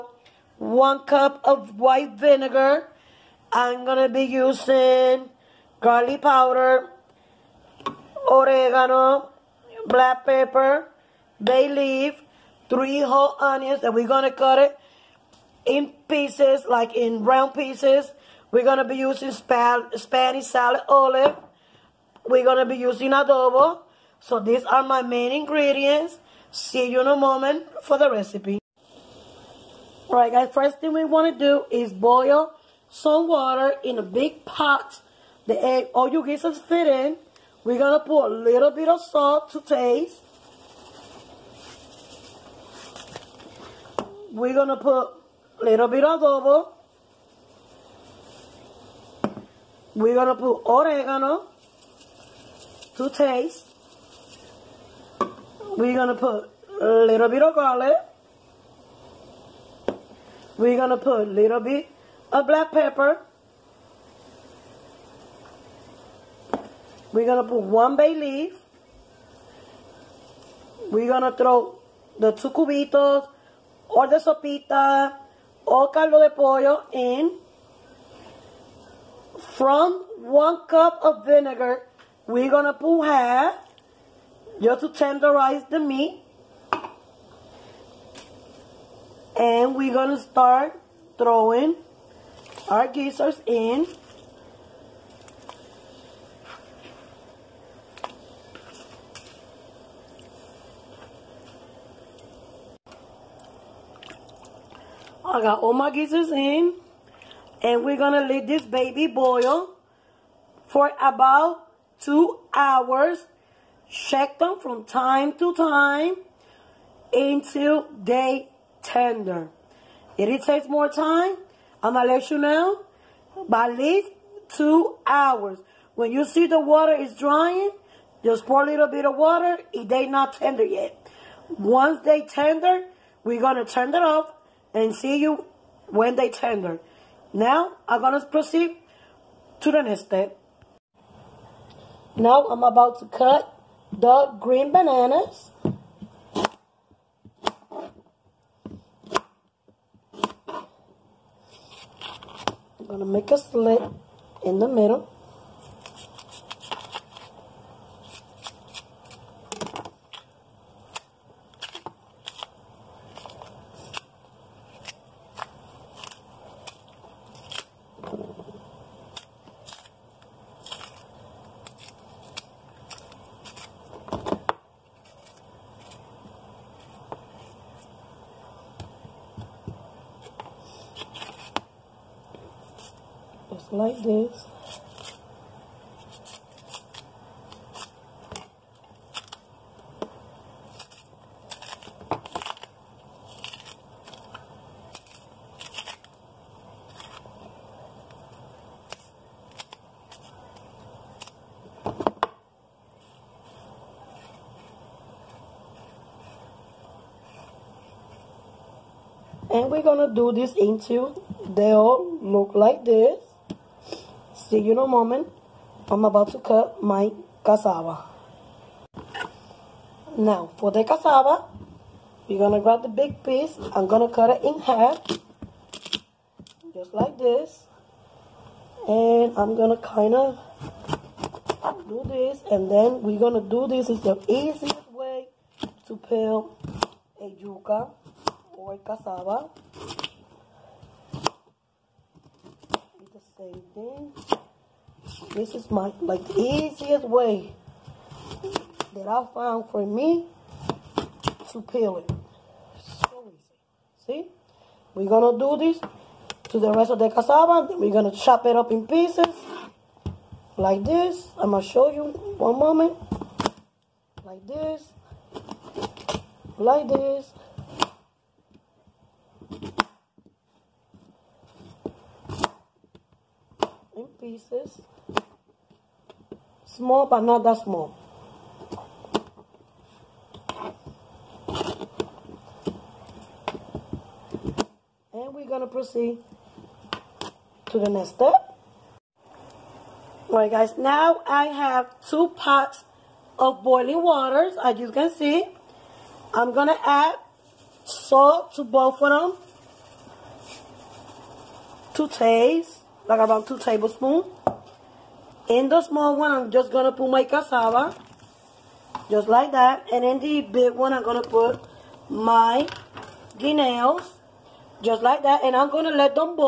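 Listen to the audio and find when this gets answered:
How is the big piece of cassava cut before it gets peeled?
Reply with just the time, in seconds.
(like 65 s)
224 s.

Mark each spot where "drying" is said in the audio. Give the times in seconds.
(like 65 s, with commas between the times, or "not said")
127 s.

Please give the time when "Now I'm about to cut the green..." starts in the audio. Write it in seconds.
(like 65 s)
142 s.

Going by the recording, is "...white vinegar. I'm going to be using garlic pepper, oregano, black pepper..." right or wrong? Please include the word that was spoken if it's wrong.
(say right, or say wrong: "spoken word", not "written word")
wrong: "powder", not "pepper".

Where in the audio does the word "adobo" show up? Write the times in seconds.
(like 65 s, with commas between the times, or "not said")
23 s, 46 s.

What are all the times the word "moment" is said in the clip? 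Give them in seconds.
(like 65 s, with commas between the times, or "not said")
27 s, 214 s, 262 s.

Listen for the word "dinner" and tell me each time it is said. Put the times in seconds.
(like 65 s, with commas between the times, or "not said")
not said.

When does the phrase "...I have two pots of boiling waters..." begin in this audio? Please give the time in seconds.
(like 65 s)
291 s.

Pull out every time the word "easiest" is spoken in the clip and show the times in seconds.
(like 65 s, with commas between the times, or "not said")
234 s, 246 s.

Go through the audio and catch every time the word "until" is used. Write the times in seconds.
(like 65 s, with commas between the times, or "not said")
117 s, 210 s.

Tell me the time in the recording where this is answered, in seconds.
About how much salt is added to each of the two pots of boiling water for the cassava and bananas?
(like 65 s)
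303 s.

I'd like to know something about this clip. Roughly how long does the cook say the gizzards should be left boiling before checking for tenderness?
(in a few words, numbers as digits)
2 hours.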